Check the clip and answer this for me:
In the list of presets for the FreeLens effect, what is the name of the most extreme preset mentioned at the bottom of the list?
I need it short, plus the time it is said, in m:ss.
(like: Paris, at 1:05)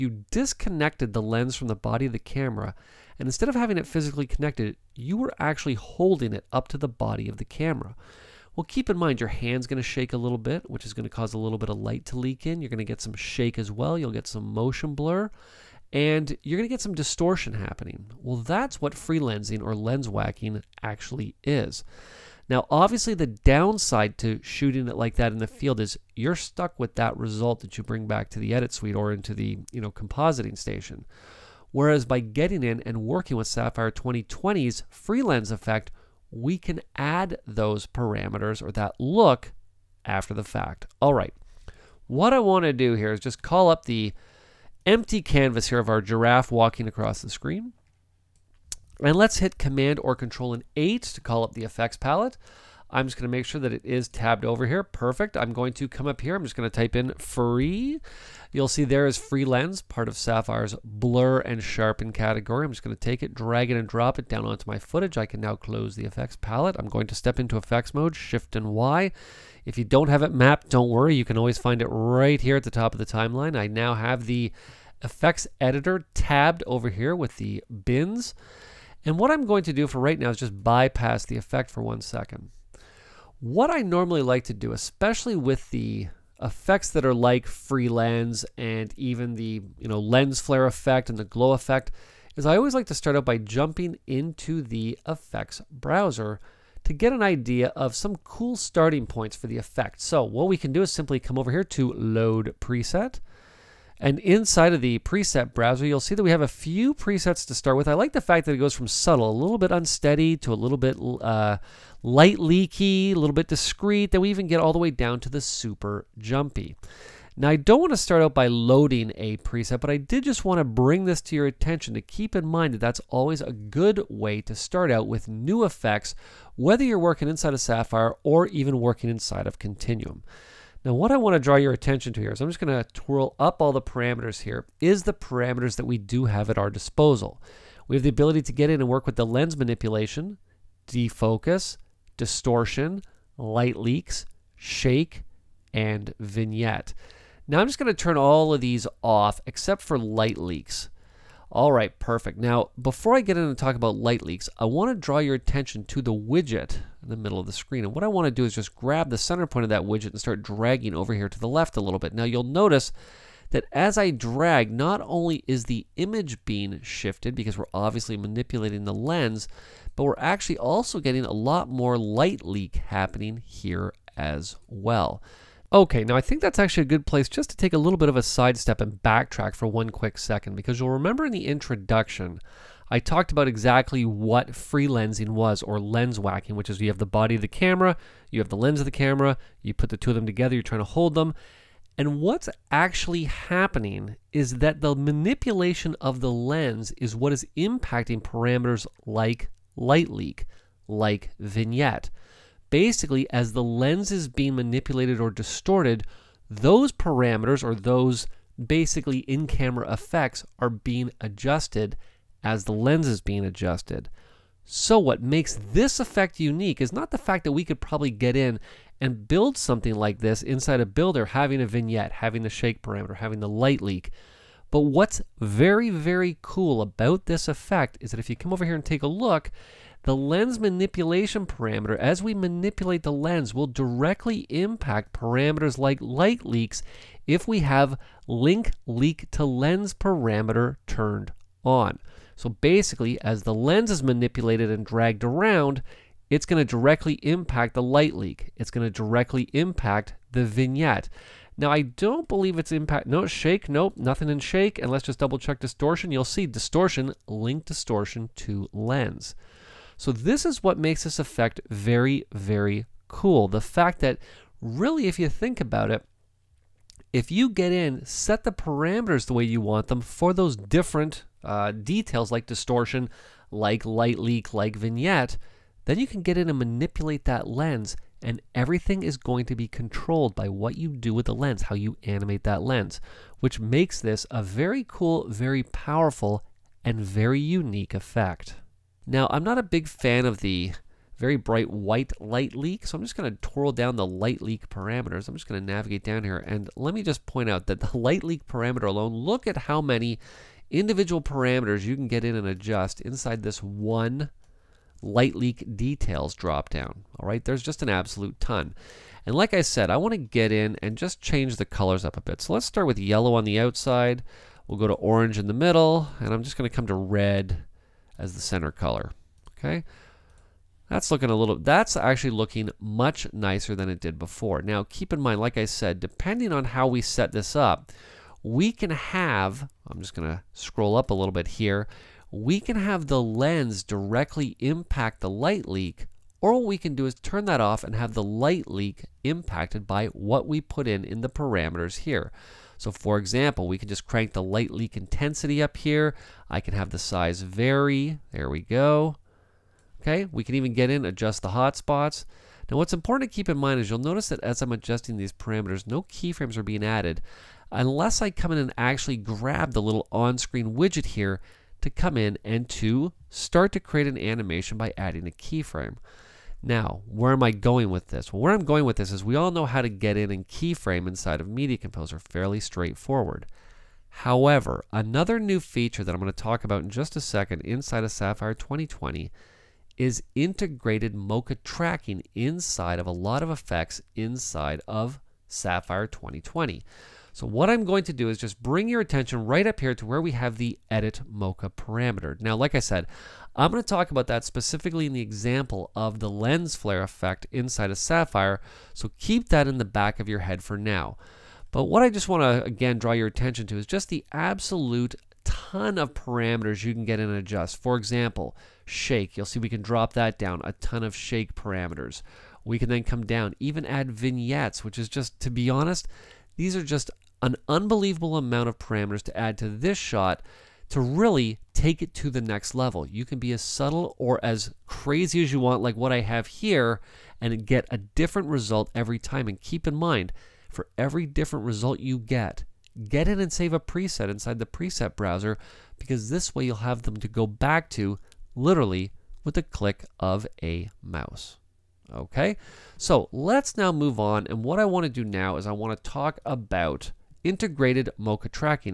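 super jumpy, at 1:55.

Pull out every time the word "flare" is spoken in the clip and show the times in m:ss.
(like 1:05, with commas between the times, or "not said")
1:30, 6:36.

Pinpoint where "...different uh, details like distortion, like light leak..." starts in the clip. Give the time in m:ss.
4:30.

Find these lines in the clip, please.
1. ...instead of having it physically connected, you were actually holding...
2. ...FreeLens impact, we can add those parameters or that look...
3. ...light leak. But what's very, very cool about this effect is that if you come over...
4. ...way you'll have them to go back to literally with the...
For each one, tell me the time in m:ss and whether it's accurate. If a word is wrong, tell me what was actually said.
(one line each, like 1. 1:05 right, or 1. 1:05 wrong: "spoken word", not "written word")
1. 0:03 right
2. 0:34 wrong: "effect", not "impact"
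3. 3:43 right
4. 7:16 right.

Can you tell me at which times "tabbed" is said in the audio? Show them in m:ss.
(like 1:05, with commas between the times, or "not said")
0:54, 1:16.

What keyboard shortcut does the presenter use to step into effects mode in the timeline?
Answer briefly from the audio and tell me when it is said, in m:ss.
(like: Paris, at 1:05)
Shift and Y, at 1:08.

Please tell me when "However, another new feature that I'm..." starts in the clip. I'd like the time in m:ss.
6:14.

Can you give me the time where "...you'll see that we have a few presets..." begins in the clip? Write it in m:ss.
1:45.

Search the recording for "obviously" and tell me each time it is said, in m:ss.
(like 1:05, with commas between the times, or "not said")
0:22, 2:47.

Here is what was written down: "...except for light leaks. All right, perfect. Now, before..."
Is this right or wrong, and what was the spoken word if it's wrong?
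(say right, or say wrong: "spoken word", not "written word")
right.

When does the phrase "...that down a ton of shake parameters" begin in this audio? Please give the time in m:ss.
6:50.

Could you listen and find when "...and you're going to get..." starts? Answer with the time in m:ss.
0:15.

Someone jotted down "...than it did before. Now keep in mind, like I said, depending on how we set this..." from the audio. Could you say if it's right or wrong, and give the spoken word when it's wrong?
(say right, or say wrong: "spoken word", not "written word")
right.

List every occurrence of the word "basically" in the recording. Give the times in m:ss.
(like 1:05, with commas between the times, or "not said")
3:22, 3:28, 4:02.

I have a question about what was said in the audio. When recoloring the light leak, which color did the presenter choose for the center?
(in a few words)
red.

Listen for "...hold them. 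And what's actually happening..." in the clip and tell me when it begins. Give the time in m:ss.
3:10.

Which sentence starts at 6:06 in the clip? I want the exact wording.
Now, where am I going with this?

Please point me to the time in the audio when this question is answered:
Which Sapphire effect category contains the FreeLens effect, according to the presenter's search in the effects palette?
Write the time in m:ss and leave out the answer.
1:00.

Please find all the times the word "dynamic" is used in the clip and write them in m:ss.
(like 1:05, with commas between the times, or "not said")
not said.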